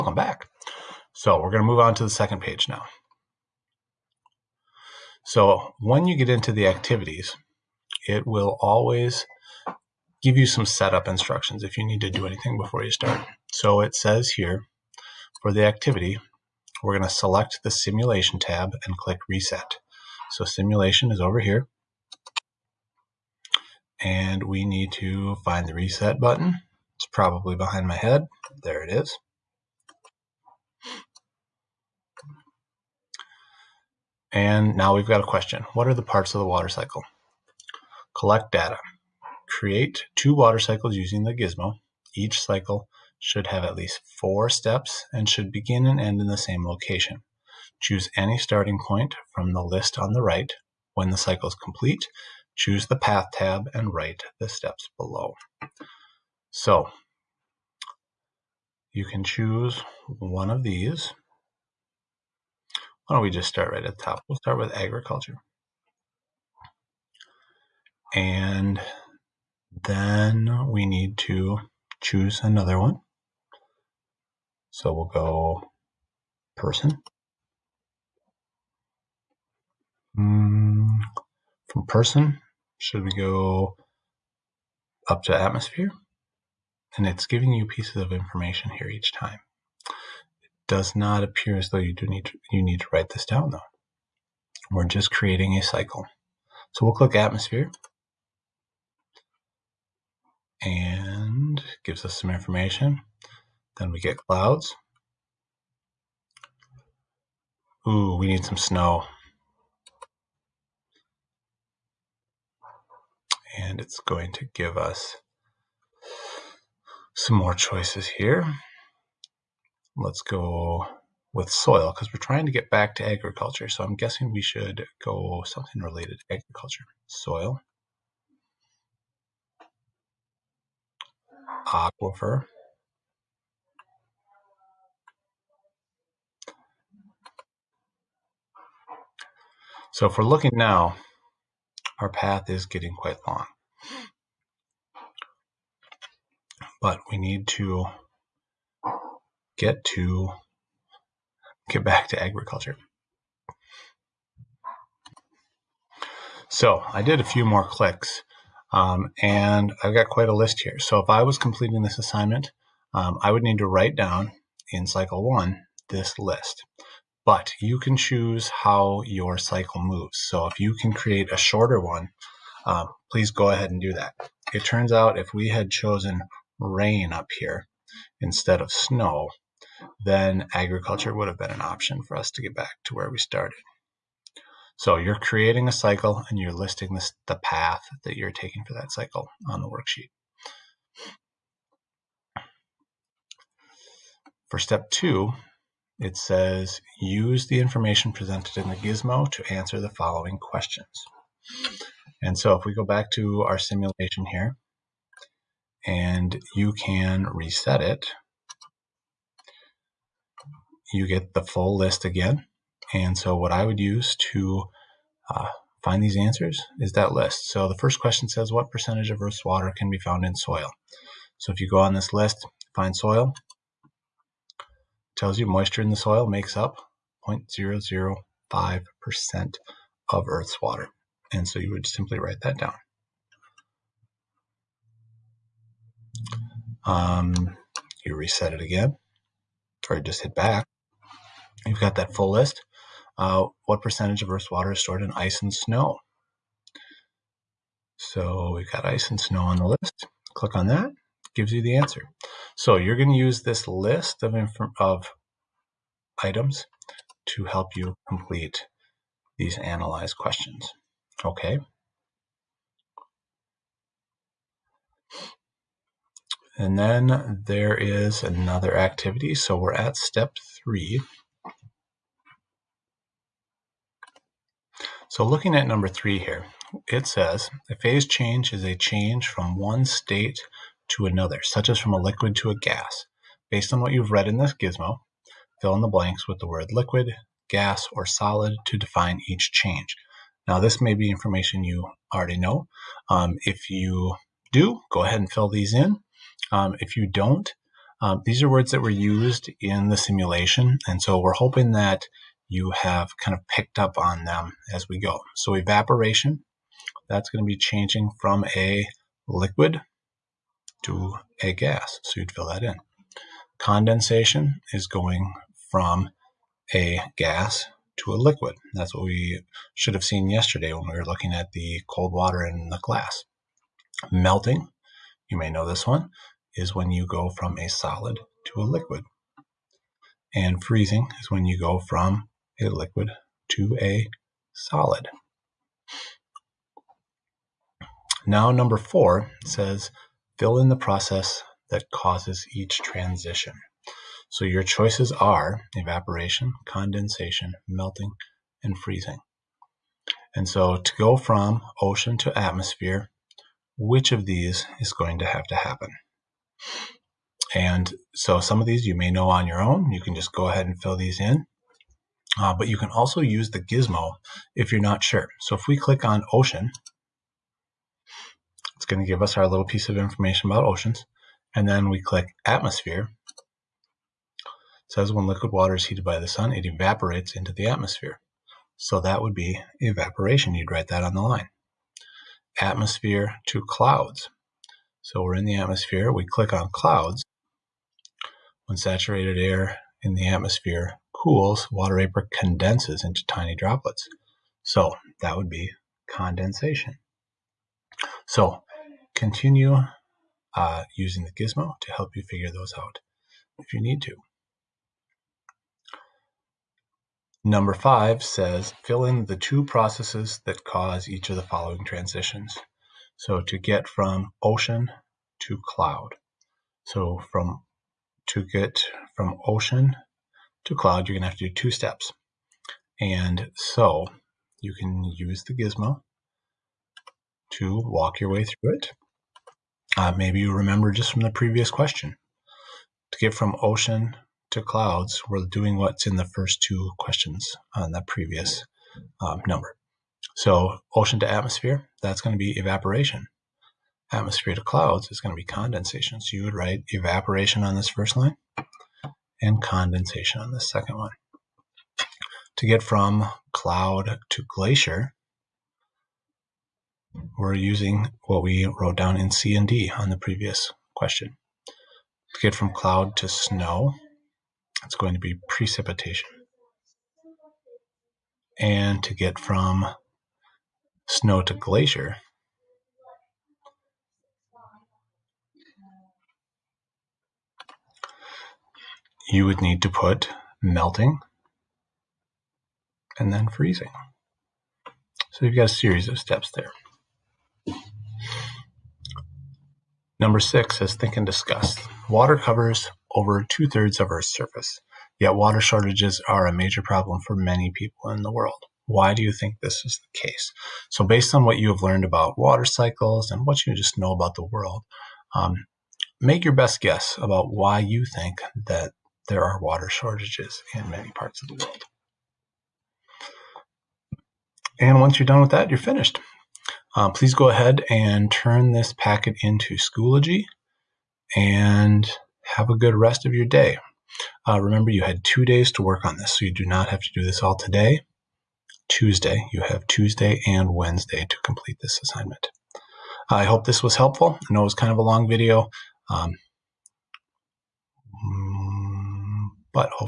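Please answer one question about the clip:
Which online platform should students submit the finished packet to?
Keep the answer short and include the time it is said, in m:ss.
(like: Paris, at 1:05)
Schoology, at 8:39.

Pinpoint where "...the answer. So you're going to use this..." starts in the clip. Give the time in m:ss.
4:11.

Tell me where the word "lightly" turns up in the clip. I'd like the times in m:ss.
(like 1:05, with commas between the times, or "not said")
not said.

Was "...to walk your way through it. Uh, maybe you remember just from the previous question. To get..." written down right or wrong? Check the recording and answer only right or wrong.
right.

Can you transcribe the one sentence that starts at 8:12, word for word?
Water covers over two thirds of Earth's surface, yet water shortages are a major problem for many people in the world.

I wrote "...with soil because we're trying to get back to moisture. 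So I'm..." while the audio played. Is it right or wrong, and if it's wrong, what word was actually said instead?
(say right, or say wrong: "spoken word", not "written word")
wrong: "agriculture", not "moisture".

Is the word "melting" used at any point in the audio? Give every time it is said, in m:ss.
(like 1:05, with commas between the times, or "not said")
5:24, 5:47, 8:00.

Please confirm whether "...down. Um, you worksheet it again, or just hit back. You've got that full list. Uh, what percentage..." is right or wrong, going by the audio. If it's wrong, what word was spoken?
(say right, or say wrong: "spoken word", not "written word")
wrong: "reset", not "worksheet".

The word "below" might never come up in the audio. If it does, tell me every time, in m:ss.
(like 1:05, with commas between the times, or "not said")
0:54.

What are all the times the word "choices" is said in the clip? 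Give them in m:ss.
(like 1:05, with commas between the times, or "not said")
1:57, 5:44.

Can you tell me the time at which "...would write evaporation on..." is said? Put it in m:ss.
7:26.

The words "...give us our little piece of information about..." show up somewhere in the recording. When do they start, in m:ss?
6:09.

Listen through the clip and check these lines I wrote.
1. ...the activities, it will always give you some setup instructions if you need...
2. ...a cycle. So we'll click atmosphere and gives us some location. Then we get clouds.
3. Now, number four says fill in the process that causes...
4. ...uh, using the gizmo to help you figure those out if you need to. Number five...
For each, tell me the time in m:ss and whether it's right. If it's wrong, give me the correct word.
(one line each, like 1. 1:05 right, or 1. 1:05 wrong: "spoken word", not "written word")
1. 0:06 right
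2. 1:35 wrong: "information", not "location"
3. 5:38 right
4. 6:40 right.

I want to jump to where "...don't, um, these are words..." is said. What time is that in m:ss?
4:57.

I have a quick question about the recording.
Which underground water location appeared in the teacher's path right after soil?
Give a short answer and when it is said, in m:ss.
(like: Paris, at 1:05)
aquifer, at 2:11.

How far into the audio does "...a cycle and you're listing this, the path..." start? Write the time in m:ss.
3:05.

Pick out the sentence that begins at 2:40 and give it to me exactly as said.
So if I was completing this assignment, um, I would need to write down in cycle one this list.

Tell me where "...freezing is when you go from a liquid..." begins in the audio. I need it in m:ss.
5:30.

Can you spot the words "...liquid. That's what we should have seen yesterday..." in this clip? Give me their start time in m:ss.
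5:18.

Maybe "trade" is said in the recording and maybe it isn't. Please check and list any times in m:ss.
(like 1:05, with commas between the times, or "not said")
not said.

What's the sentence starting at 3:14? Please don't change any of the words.
For step two, it says use the information presented in the gizmo to answer the following questions.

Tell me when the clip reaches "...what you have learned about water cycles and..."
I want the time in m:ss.
8:21.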